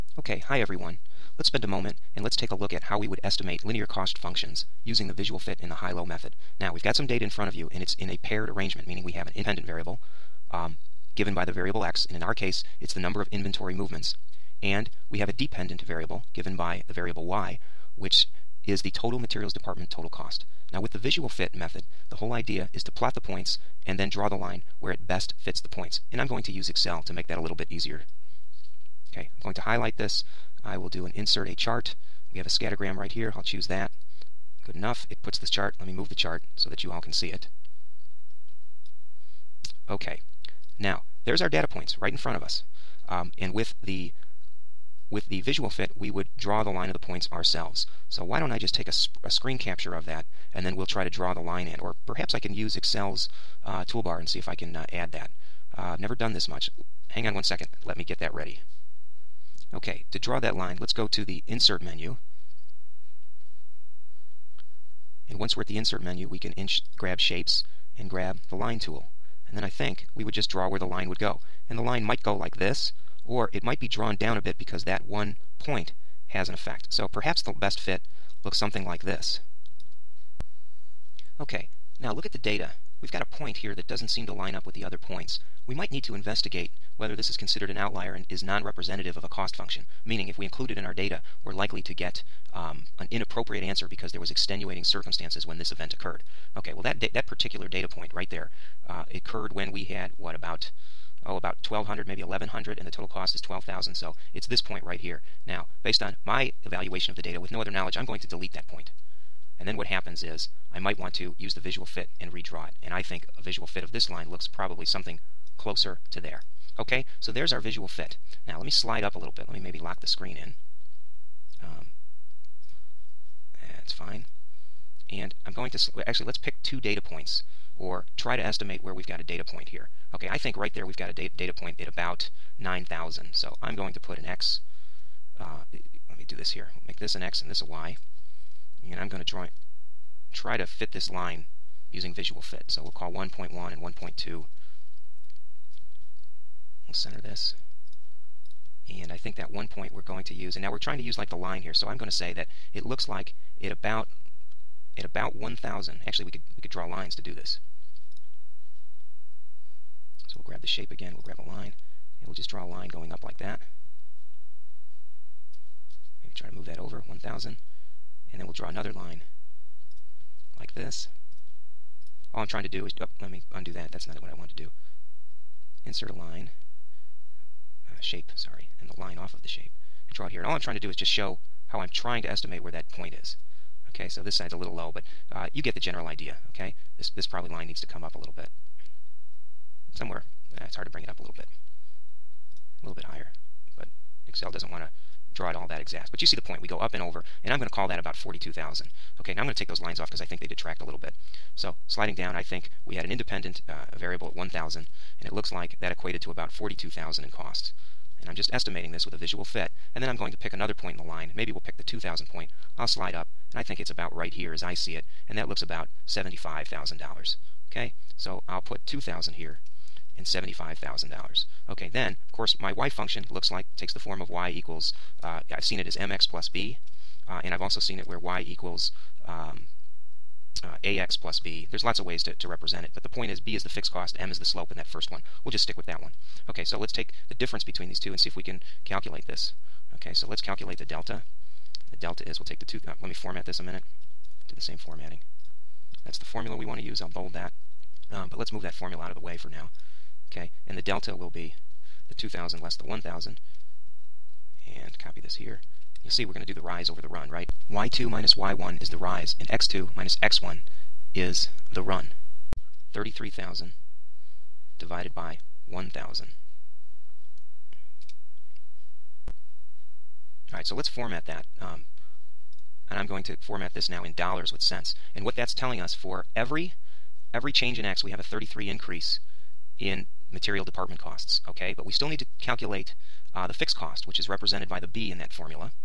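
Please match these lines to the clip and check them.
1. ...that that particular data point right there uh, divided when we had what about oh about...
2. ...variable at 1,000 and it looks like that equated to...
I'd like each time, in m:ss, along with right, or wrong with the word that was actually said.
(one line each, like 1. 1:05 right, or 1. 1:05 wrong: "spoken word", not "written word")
1. 1:36 wrong: "occurred", not "divided"
2. 3:23 right.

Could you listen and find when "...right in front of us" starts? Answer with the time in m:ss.
0:41.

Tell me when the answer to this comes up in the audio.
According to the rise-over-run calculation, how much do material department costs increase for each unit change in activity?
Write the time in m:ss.
4:38.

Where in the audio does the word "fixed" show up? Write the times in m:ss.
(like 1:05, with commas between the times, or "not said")
3:53, 4:43.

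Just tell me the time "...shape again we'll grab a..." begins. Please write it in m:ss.
2:40.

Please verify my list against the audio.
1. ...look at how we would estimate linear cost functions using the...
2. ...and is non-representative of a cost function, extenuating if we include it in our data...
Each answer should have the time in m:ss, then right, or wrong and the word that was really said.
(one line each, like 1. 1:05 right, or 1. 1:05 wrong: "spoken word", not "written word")
1. 0:02 right
2. 1:28 wrong: "meaning", not "extenuating".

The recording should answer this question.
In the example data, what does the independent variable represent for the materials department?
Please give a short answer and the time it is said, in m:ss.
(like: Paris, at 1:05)
Number of inventory movements, at 0:12.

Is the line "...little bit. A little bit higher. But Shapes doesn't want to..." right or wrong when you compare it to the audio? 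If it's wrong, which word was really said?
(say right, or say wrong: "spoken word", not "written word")
wrong: "Excel", not "Shapes".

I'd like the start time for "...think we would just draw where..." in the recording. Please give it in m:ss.
1:09.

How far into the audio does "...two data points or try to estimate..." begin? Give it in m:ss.
2:06.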